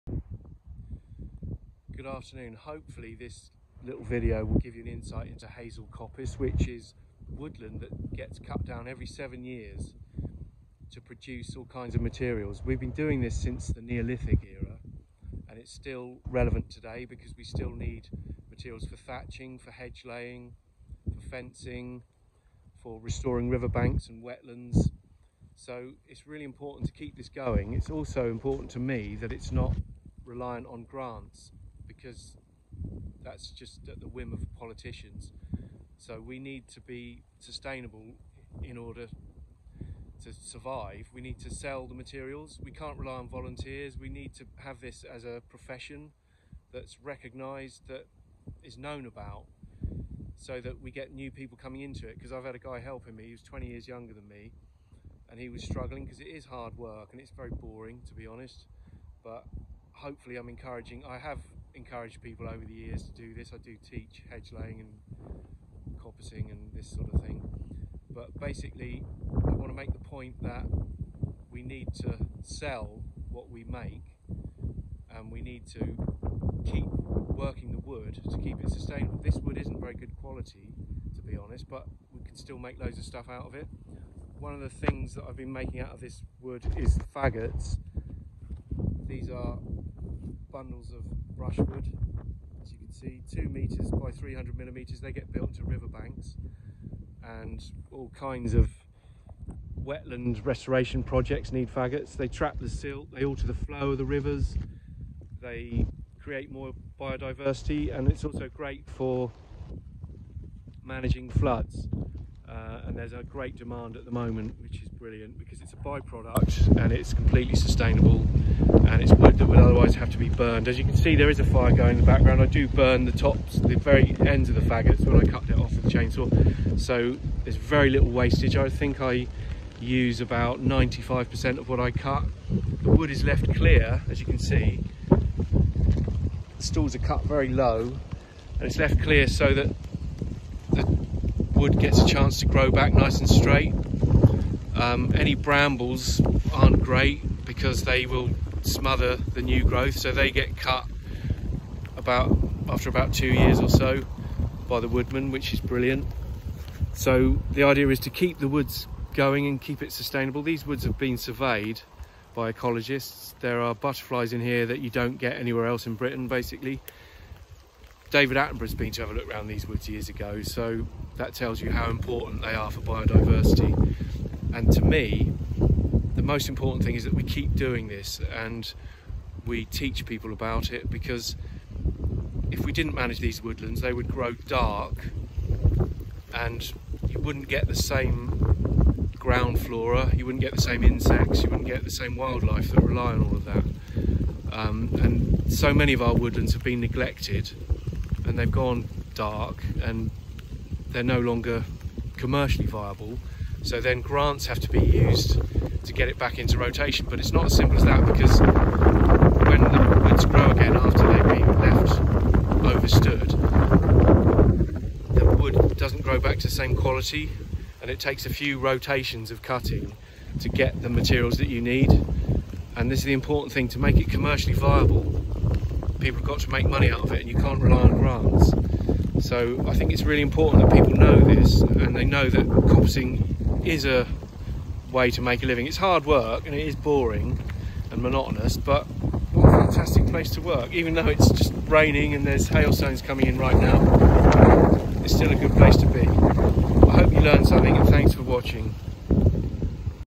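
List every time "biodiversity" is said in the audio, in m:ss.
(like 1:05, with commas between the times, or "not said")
1:46, 2:52.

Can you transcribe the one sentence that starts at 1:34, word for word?
They get built to riverbanks and all kinds of wetland restoration projects need faggots.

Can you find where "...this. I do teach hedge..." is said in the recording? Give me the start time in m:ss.
1:03.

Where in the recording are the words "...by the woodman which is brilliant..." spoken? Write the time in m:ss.
2:34.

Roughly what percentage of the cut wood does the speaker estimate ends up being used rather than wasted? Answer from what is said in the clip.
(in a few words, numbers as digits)
95%.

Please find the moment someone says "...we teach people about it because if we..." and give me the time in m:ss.
2:59.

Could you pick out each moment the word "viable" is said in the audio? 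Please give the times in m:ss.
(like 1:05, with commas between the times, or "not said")
3:22, 3:44.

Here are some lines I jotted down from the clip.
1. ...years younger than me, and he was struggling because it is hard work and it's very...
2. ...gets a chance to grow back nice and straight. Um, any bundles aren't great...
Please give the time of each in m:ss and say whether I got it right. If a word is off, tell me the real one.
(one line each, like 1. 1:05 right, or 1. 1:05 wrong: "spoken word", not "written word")
1. 0:53 right
2. 2:21 wrong: "brambles", not "bundles".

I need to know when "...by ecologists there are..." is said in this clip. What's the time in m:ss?
2:42.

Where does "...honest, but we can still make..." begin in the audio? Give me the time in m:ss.
1:21.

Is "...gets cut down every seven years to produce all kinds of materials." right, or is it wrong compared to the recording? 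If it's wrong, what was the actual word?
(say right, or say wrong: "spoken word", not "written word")
right.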